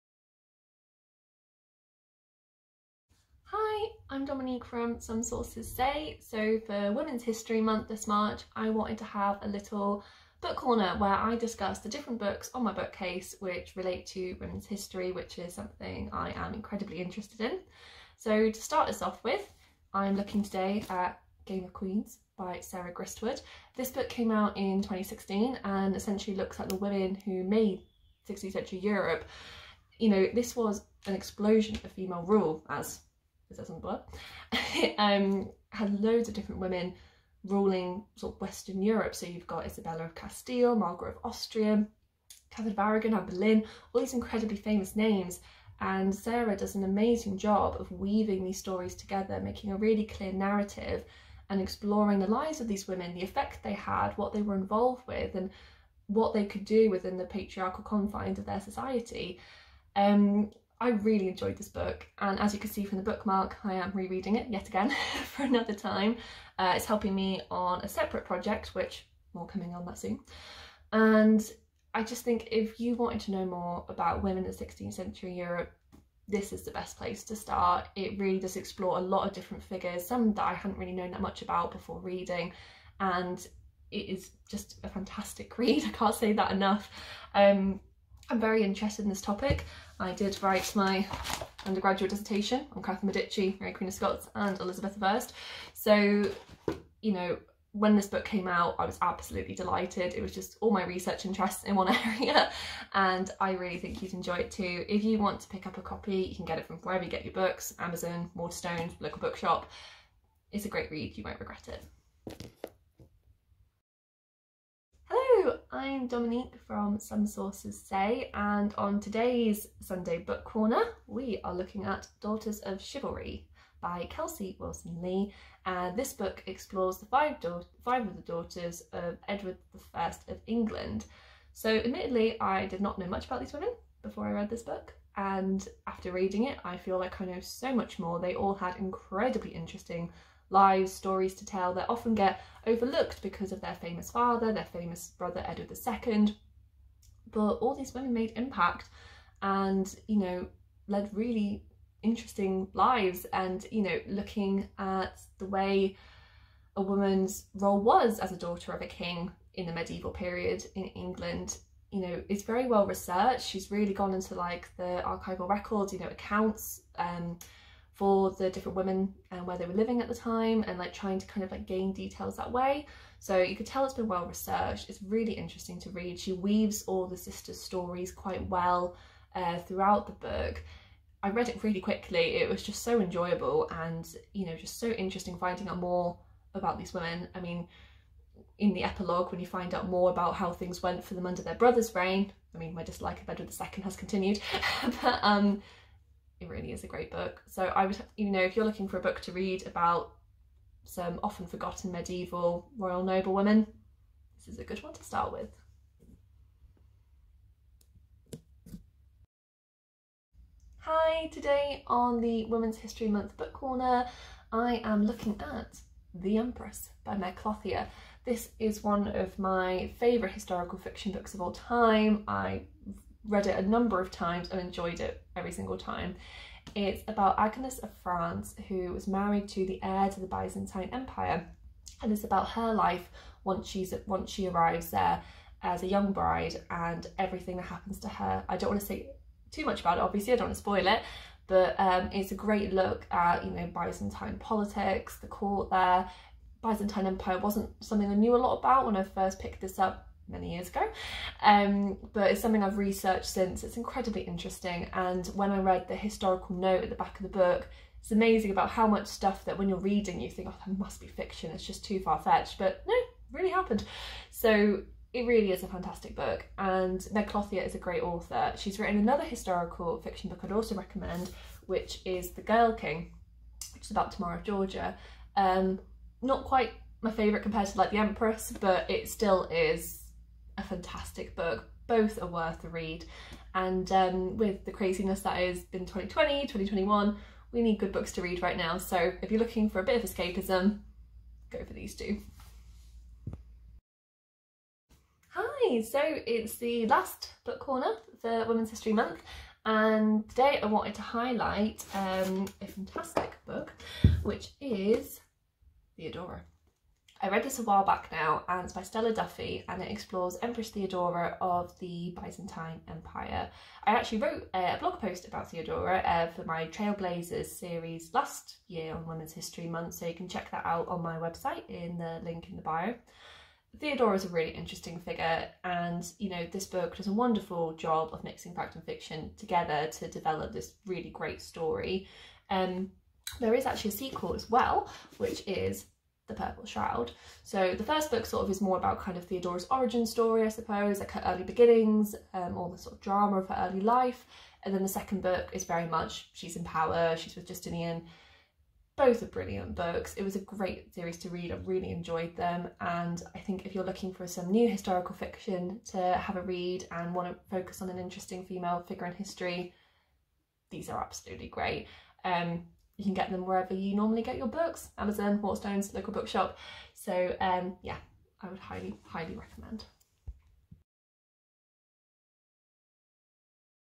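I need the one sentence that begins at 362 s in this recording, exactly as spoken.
Um, you can get them wherever you normally get your books, Amazon, Waterstones, local bookshop.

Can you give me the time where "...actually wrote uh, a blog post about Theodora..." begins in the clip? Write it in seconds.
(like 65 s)
313 s.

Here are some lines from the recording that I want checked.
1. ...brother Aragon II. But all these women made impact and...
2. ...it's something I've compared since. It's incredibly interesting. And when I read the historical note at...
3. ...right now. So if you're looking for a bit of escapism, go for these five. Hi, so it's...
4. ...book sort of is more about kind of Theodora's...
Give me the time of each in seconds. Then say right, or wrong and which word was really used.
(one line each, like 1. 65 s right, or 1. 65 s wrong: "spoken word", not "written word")
1. 145 s wrong: "Edward", not "Aragon"
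2. 252 s wrong: "researched", not "compared"
3. 288 s wrong: "two", not "five"
4. 338 s right.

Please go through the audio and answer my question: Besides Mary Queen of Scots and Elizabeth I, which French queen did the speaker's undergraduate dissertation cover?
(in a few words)
Catherine Medici.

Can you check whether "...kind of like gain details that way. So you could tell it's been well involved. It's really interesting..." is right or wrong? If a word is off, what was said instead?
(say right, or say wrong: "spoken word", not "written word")
wrong: "researched", not "involved".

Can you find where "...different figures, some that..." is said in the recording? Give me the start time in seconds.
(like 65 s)
79 s.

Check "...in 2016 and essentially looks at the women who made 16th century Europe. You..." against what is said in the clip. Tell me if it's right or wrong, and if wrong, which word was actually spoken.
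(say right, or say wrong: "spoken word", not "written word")
right.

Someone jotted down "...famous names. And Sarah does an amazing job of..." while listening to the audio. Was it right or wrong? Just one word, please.
right.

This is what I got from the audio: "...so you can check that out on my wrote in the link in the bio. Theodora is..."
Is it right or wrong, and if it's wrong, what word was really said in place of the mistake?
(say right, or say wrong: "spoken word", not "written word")
wrong: "website", not "wrote".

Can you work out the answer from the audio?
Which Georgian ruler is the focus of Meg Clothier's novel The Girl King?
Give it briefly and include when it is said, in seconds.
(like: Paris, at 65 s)
Tamara of Georgia, at 274 s.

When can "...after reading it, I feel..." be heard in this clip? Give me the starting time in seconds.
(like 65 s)
135 s.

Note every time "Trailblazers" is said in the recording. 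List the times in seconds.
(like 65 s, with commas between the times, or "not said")
316 s.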